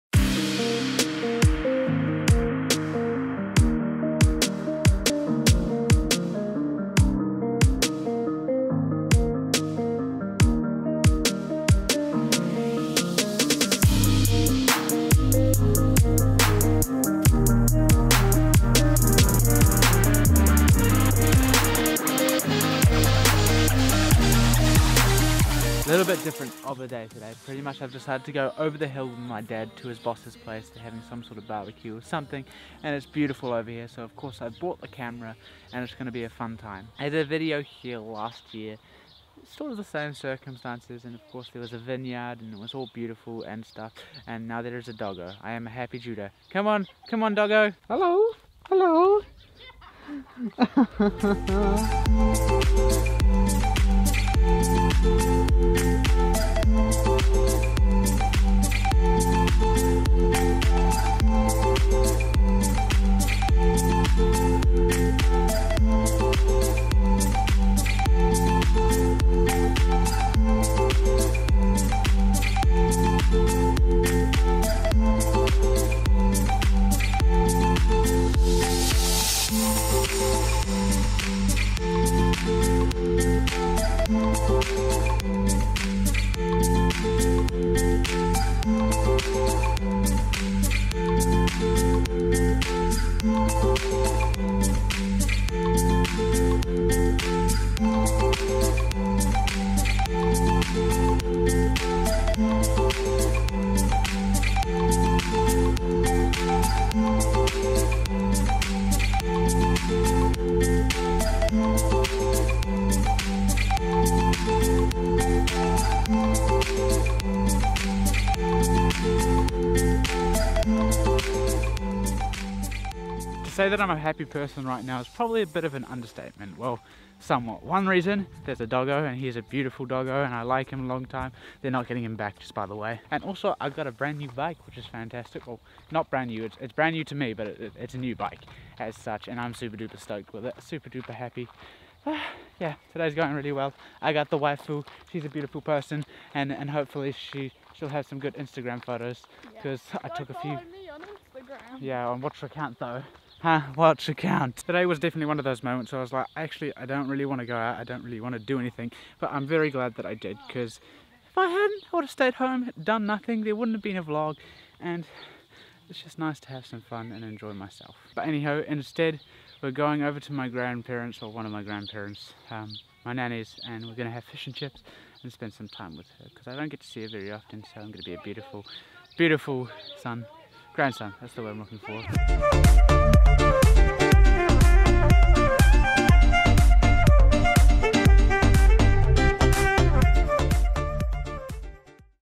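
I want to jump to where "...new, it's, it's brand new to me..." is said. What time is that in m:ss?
2:16.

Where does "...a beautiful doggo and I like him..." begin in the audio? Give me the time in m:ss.
2:09.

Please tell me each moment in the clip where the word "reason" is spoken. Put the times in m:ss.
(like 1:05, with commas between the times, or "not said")
2:07.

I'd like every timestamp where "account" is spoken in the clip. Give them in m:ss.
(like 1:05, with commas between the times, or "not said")
2:32.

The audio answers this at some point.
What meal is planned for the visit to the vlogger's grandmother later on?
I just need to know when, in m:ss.
2:54.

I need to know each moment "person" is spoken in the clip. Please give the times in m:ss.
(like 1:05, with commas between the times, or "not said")
2:04, 2:25.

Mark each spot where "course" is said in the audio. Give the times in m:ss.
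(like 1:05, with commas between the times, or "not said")
0:34, 0:41.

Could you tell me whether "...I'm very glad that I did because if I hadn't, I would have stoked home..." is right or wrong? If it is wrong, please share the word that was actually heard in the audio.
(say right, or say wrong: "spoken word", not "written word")
wrong: "stayed", not "stoked".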